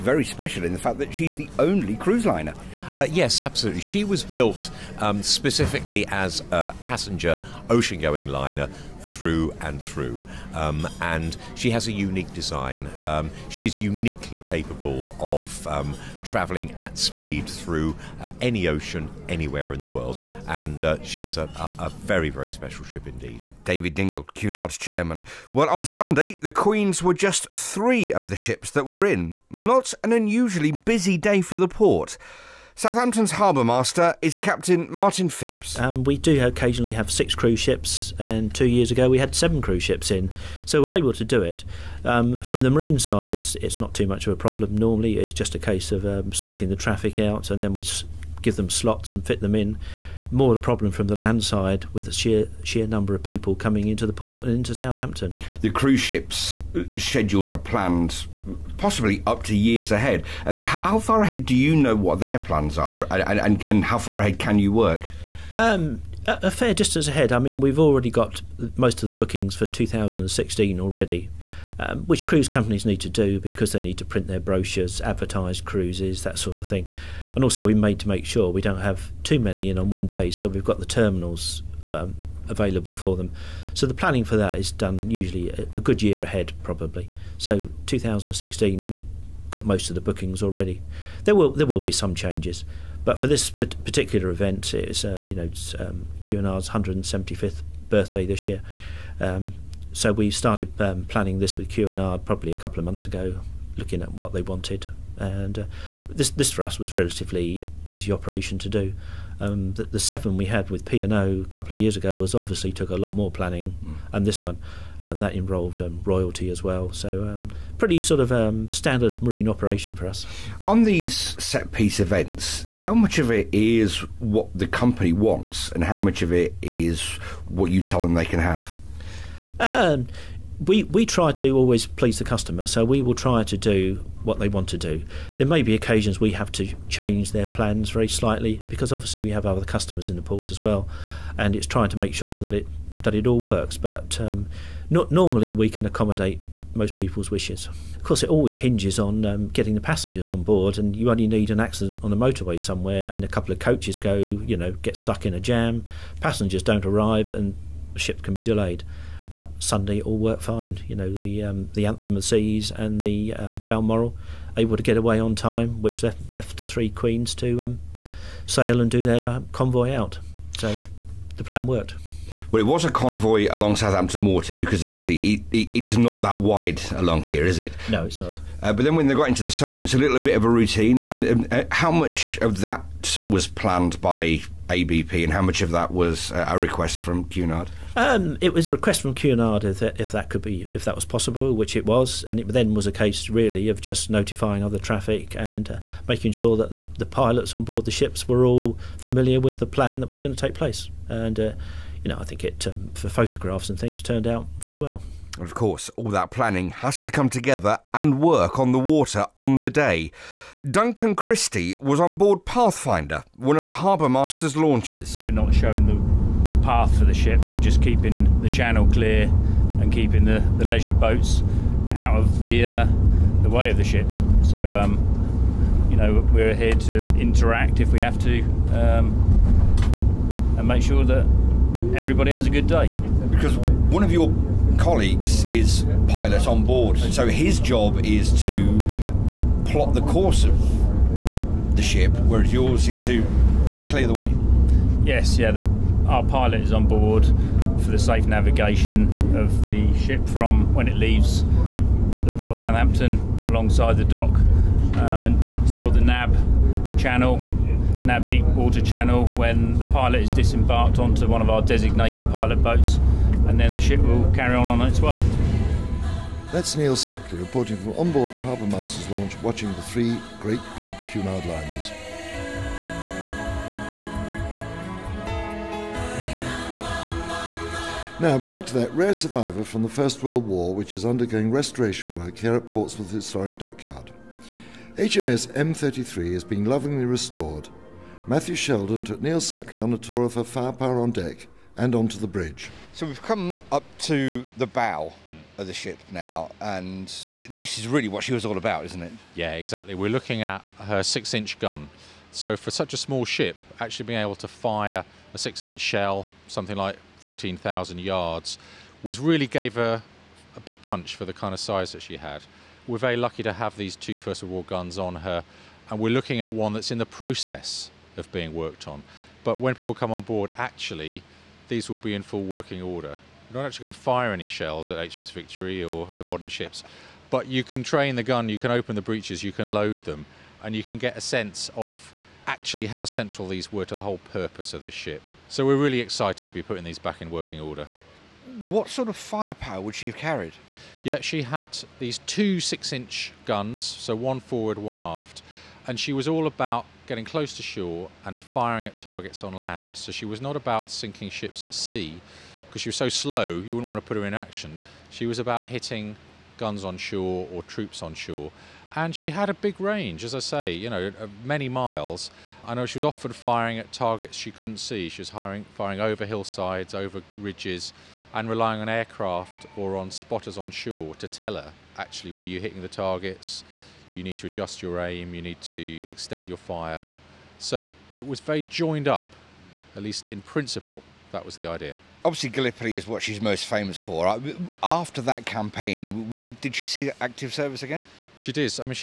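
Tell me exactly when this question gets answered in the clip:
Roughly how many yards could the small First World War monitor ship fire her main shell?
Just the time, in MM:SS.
05:07.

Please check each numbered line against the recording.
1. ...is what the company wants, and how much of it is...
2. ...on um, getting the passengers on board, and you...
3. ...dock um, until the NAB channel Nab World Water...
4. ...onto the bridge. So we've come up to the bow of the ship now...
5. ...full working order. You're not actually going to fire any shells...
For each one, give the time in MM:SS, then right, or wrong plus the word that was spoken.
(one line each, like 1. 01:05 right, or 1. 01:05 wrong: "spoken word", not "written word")
1. 02:03 right
2. 02:28 right
3. 04:14 wrong: "Deep", not "World"
4. 04:51 right
5. 05:22 right.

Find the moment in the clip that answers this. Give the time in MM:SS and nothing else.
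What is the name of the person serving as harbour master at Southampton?
00:34.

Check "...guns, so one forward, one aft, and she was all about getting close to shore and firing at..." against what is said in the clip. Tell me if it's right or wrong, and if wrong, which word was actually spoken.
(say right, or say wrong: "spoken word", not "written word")
right.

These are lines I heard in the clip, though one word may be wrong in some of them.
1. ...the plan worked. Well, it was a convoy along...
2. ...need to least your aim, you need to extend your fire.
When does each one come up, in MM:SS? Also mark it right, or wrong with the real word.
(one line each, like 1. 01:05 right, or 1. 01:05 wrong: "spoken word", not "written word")
1. 02:51 right
2. 06:14 wrong: "adjust", not "least".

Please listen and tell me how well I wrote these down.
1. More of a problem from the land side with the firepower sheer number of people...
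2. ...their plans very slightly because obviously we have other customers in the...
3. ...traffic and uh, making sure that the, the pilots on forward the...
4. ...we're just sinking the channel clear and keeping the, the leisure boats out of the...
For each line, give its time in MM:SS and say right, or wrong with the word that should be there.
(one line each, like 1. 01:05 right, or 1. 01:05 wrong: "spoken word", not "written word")
1. 00:50 wrong: "sheer", not "firepower"
2. 02:17 right
3. 03:14 wrong: "board", not "forward"
4. 03:37 wrong: "keeping", not "sinking".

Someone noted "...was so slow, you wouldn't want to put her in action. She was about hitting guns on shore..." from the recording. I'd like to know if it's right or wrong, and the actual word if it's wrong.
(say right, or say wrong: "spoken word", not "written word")
right.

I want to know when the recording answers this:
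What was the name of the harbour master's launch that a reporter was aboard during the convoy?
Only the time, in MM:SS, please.
03:32.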